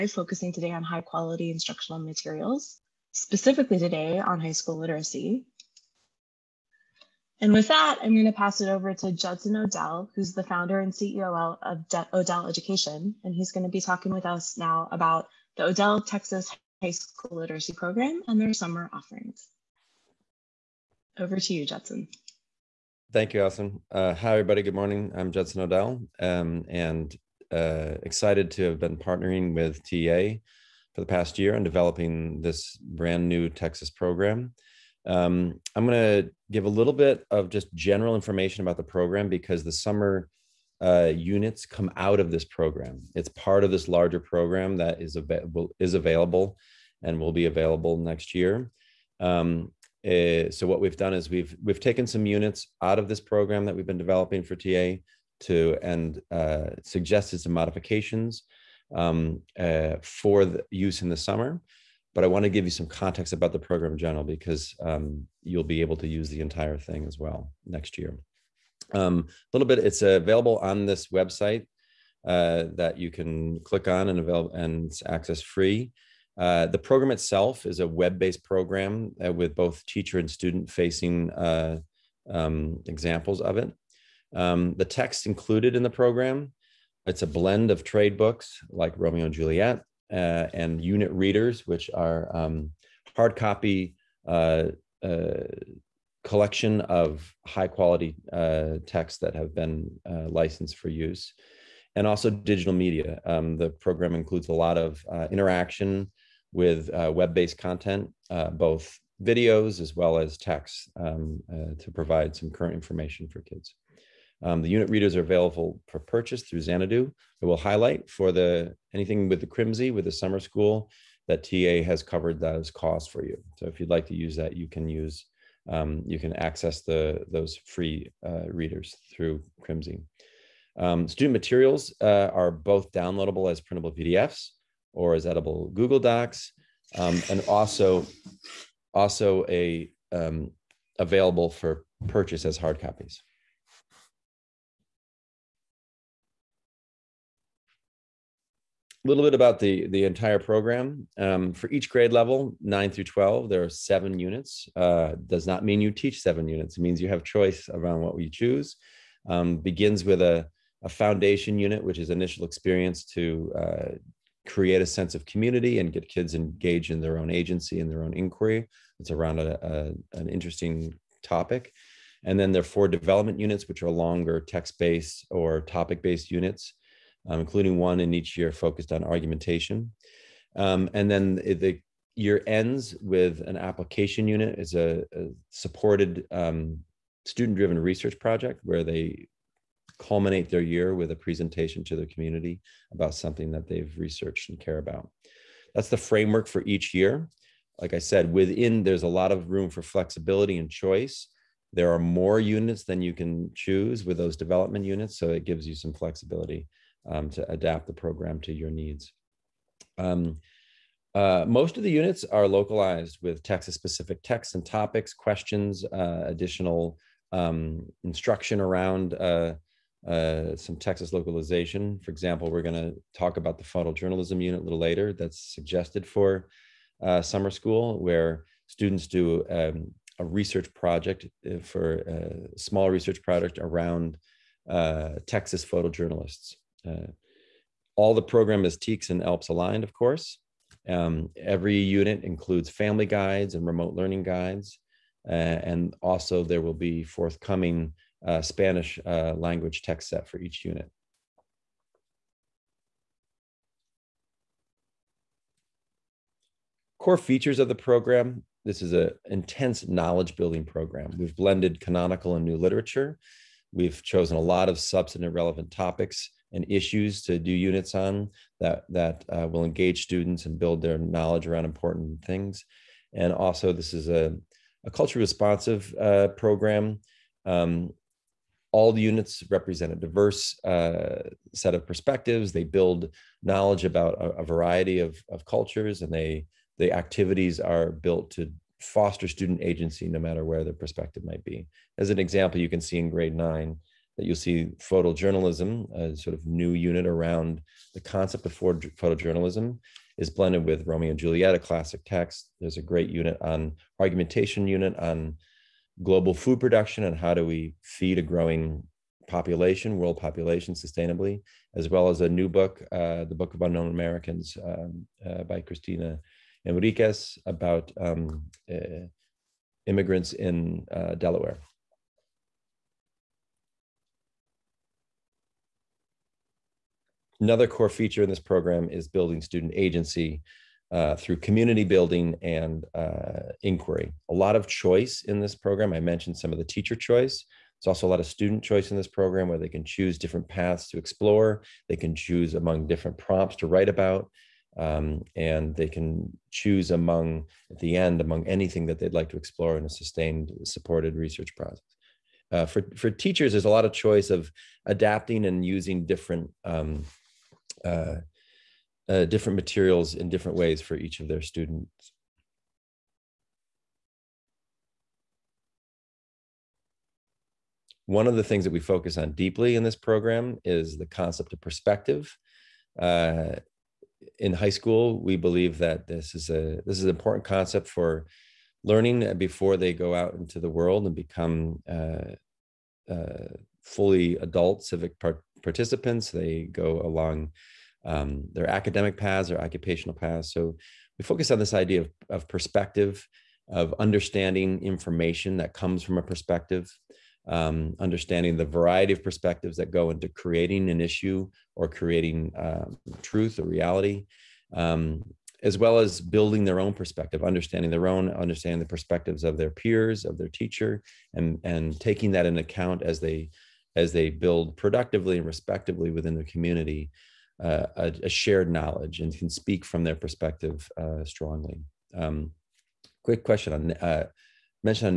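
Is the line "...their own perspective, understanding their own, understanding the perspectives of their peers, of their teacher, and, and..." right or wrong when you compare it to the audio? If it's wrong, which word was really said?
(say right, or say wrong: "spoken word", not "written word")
right.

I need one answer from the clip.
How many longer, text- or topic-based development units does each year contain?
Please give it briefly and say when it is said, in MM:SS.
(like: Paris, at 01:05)
4, at 02:52.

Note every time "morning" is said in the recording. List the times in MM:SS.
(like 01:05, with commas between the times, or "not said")
00:24.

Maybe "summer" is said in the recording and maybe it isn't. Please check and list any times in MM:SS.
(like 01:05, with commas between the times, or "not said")
00:18, 00:39, 01:01, 02:00, 03:47.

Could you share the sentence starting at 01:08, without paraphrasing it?
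Um, a um, little bit, it's available on this website uh, that you can click on and avail- and it's access free.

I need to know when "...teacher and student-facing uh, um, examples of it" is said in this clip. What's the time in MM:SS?
01:19.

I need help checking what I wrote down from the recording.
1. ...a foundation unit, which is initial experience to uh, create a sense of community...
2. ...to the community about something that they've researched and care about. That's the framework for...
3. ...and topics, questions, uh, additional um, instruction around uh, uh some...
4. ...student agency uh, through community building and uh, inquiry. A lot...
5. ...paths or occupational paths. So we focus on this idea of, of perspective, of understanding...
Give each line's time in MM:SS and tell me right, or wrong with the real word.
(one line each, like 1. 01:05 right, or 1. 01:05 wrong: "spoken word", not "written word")
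1. 02:40 right
2. 03:11 right
3. 03:34 right
4. 05:29 right
5. 06:29 right.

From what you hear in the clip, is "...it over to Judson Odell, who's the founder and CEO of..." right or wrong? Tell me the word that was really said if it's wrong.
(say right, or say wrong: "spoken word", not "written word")
right.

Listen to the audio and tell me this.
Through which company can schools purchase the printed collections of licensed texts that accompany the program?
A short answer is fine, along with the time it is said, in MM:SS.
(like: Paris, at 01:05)
XanEdu, at 01:56.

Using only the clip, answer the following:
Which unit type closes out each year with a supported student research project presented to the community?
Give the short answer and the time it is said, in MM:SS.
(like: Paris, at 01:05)
application unit, at 03:03.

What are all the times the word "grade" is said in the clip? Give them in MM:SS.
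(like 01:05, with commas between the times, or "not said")
02:31, 04:53.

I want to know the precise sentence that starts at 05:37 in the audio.
There's also a lot of student choice in this program where they can choose different paths to explore.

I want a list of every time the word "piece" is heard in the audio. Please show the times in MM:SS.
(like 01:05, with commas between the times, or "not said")
not said.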